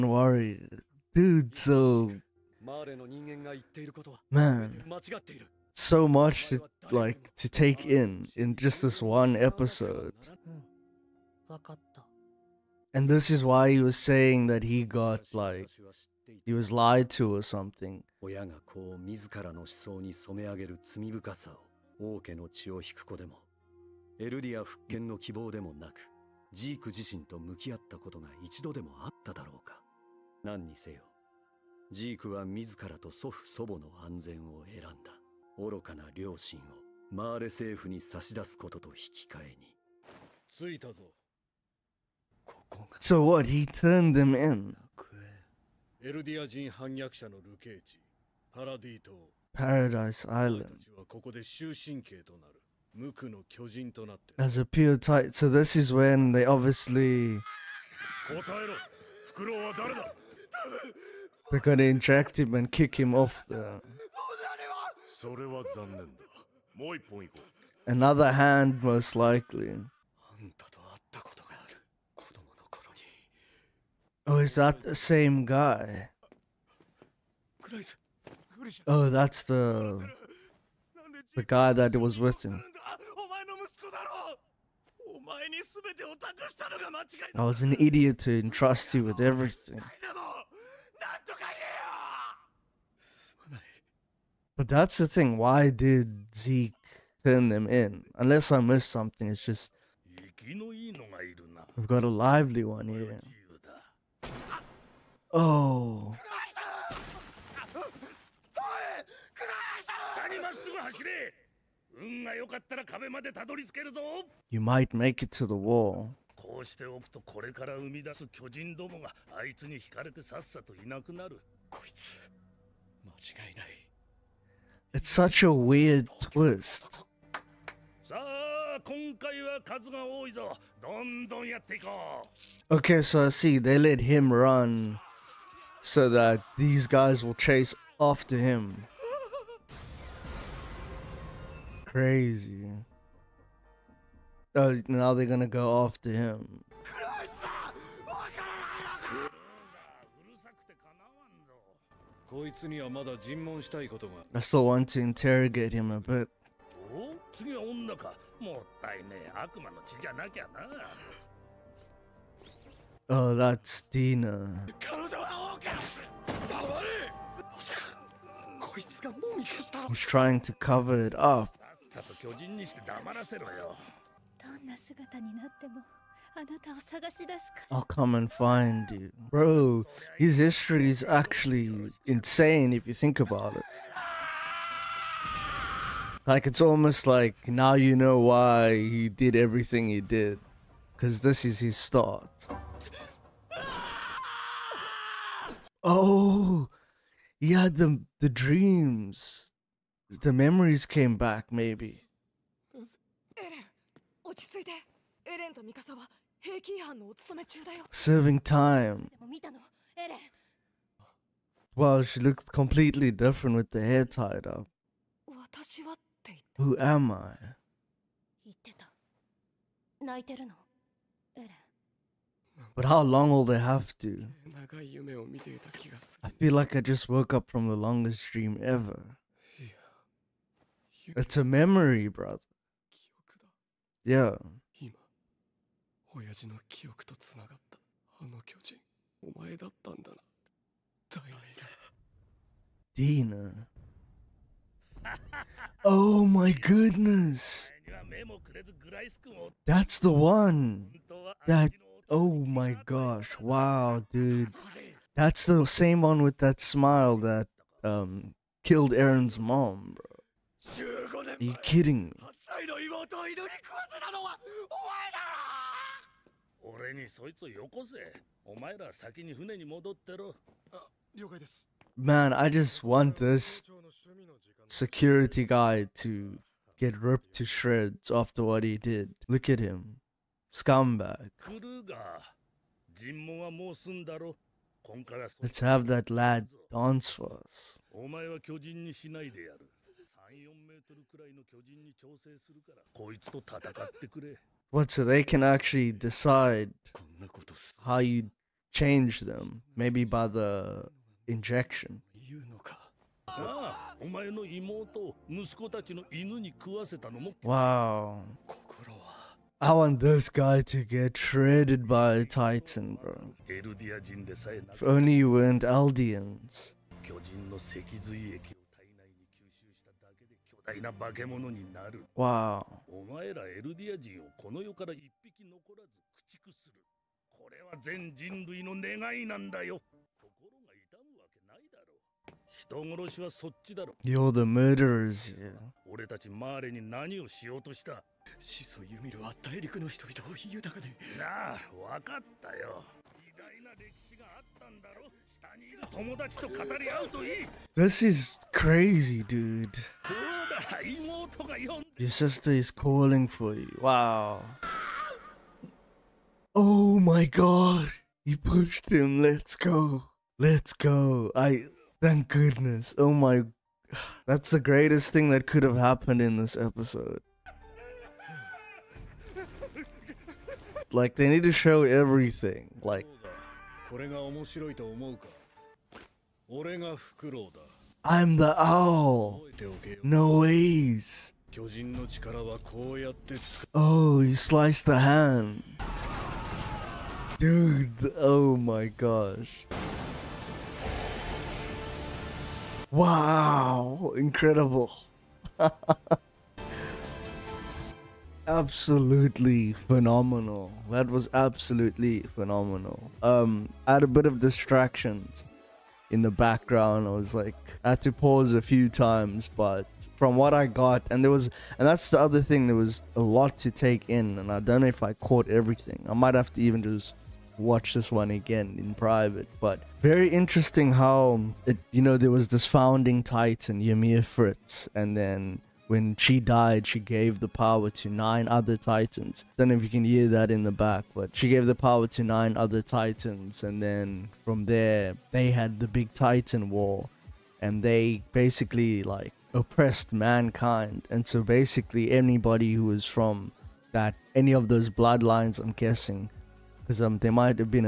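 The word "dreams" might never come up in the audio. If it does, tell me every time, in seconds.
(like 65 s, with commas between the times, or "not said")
198 s, 228 s.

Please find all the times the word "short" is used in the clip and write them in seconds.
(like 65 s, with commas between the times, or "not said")
not said.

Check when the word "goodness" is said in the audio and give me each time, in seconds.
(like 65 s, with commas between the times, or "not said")
246 s, 362 s.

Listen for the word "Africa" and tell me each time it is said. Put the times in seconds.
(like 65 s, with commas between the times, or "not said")
not said.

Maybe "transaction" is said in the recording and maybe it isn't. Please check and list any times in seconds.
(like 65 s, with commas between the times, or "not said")
not said.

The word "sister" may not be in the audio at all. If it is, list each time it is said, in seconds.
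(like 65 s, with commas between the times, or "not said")
352 s.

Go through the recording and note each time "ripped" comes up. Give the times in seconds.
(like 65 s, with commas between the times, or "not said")
276 s.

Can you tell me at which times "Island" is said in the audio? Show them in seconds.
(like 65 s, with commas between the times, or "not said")
50 s.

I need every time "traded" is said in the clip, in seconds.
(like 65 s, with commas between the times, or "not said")
311 s.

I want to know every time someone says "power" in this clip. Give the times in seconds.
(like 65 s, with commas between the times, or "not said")
427 s, 431 s.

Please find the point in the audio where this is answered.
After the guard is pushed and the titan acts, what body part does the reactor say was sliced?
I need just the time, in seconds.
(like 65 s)
384 s.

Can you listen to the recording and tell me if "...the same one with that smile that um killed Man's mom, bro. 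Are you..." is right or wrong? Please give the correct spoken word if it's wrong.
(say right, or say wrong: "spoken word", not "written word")
wrong: "Eren", not "Man".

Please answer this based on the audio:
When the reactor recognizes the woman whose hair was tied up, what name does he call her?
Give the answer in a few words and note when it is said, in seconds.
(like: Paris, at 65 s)
Tina, at 163 s.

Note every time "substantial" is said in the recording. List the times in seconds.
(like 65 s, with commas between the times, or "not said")
not said.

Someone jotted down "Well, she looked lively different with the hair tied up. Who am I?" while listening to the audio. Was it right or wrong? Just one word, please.
wrong.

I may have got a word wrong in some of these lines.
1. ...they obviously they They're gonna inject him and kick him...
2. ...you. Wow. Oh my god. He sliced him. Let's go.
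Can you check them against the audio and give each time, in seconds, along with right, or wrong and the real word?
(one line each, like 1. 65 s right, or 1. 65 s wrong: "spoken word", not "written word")
1. 56 s right
2. 353 s wrong: "pushed", not "sliced".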